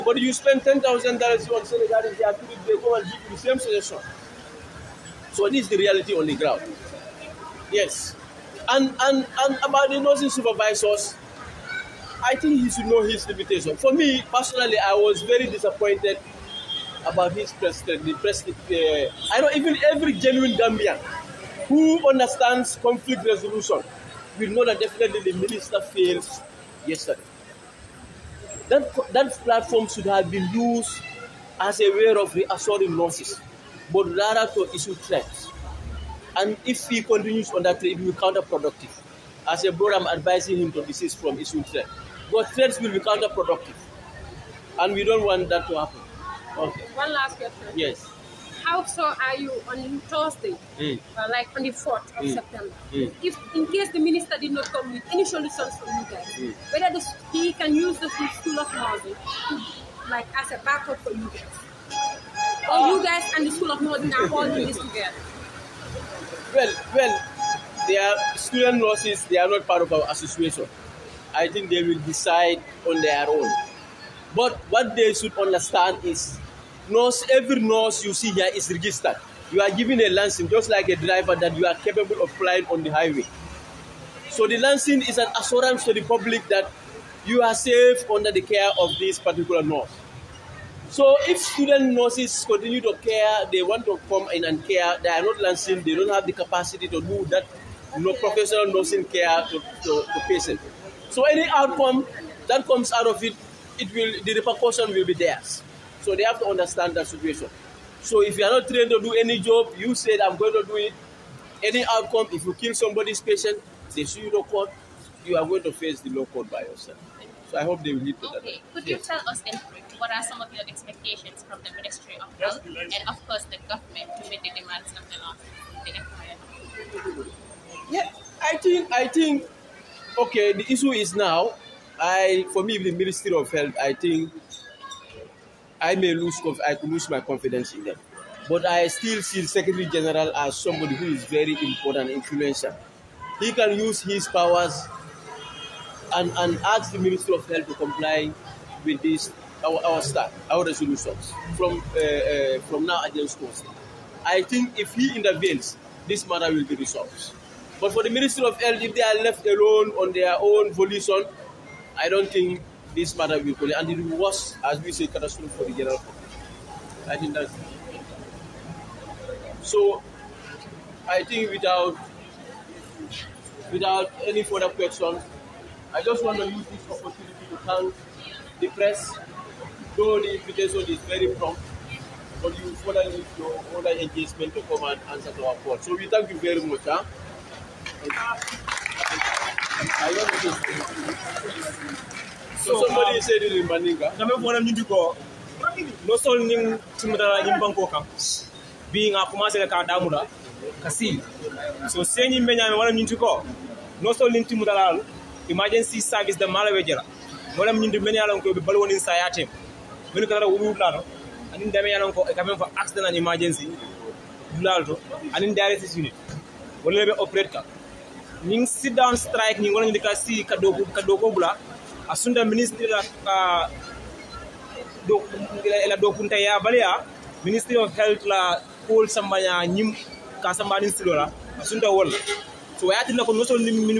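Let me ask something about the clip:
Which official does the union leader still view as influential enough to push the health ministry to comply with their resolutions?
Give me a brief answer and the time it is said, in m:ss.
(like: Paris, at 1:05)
Secretary General, at 2:19.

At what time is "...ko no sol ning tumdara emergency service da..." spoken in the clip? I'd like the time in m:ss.
3:23.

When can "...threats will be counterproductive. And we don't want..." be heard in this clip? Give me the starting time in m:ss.
0:42.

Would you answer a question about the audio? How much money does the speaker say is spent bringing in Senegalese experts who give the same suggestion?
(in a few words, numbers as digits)
$10,000.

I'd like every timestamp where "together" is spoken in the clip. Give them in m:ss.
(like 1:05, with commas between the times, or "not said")
1:04.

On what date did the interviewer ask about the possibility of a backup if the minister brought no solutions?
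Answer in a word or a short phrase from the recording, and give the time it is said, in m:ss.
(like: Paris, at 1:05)
4th of September, at 0:51.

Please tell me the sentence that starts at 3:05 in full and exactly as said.
So we thank you very much.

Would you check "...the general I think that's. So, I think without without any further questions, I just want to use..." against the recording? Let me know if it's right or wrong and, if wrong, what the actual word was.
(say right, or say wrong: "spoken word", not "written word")
right.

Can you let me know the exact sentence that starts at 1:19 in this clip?
You are given a license just like a driver that you are capable of flying on the highway.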